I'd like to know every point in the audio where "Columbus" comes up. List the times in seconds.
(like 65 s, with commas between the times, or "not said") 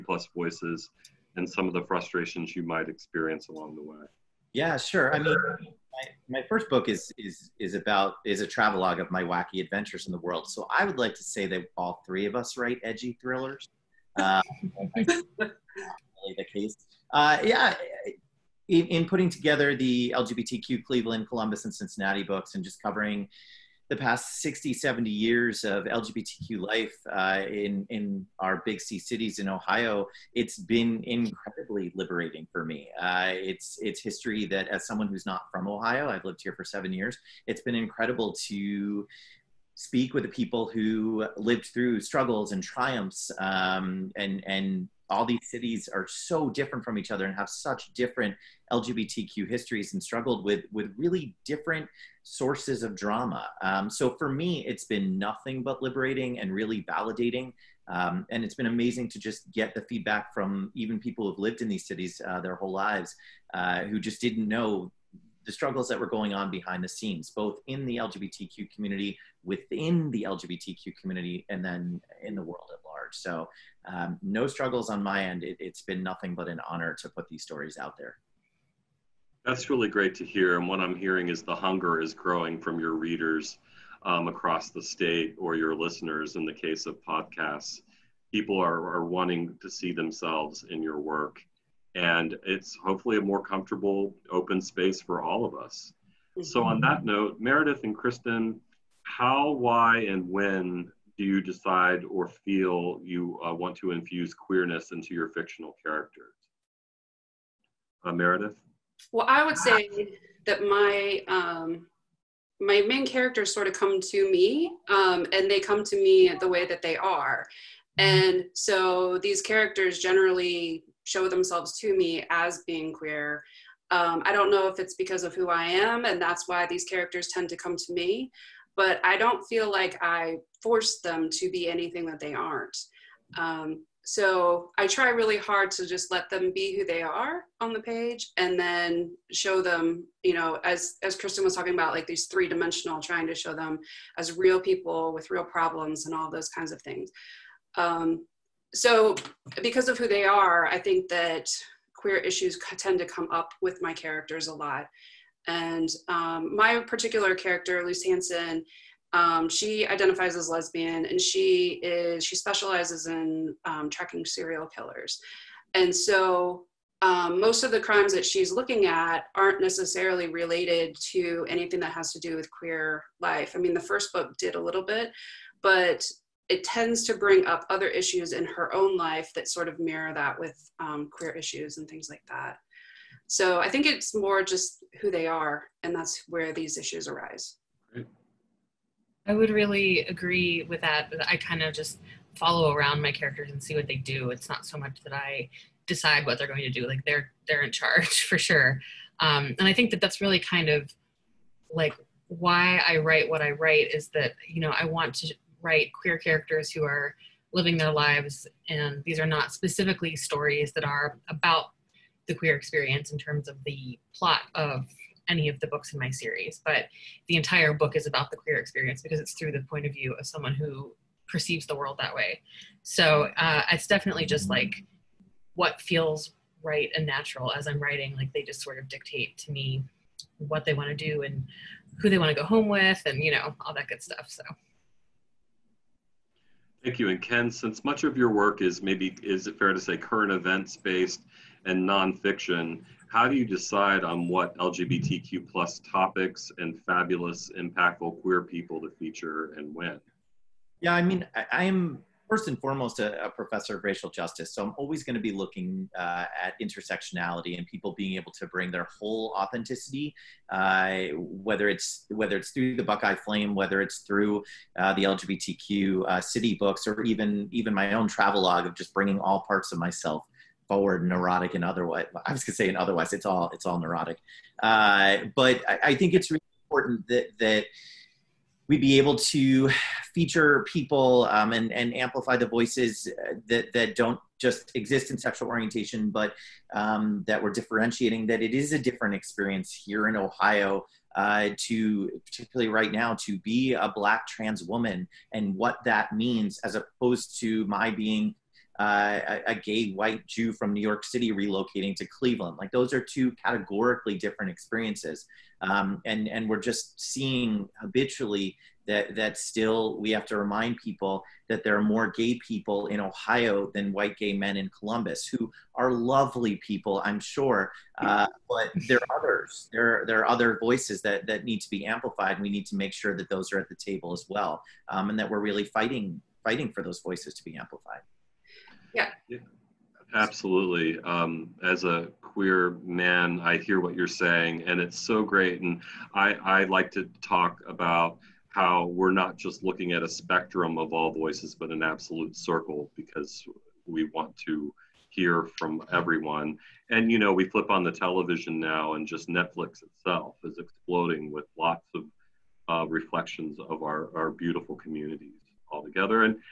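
21 s, 314 s.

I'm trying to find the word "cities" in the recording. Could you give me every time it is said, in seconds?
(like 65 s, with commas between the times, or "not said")
28 s, 45 s, 61 s.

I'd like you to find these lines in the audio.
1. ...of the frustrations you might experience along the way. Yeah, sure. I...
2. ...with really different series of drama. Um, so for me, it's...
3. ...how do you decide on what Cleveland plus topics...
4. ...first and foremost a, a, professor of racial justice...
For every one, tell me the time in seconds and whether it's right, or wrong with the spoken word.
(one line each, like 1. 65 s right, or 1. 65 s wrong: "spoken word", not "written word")
1. 1 s right
2. 50 s wrong: "sources", not "series"
3. 243 s wrong: "LGBTQ", not "Cleveland"
4. 252 s right.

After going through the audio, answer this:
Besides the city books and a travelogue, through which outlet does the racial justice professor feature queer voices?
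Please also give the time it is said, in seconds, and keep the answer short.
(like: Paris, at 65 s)
the Buckeye Flame, at 262 s.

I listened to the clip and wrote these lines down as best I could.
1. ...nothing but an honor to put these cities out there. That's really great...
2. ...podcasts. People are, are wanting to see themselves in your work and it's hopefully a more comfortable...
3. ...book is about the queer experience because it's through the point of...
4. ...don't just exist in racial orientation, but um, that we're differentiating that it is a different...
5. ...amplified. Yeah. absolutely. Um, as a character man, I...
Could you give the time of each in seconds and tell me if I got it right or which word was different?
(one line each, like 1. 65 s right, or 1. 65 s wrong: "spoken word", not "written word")
1. 76 s wrong: "stories", not "cities"
2. 87 s right
3. 217 s right
4. 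283 s wrong: "sexual", not "racial"
5. 327 s wrong: "queer", not "character".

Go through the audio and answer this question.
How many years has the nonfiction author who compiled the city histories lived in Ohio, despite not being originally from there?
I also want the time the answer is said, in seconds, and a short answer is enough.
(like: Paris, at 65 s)
7, at 36 s.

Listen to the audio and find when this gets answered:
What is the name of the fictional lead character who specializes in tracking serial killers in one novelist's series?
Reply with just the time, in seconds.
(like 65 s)
157 s.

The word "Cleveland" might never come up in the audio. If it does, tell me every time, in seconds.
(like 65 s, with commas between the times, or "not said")
20 s, 302 s.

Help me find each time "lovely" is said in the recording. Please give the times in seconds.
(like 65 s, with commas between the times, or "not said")
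315 s.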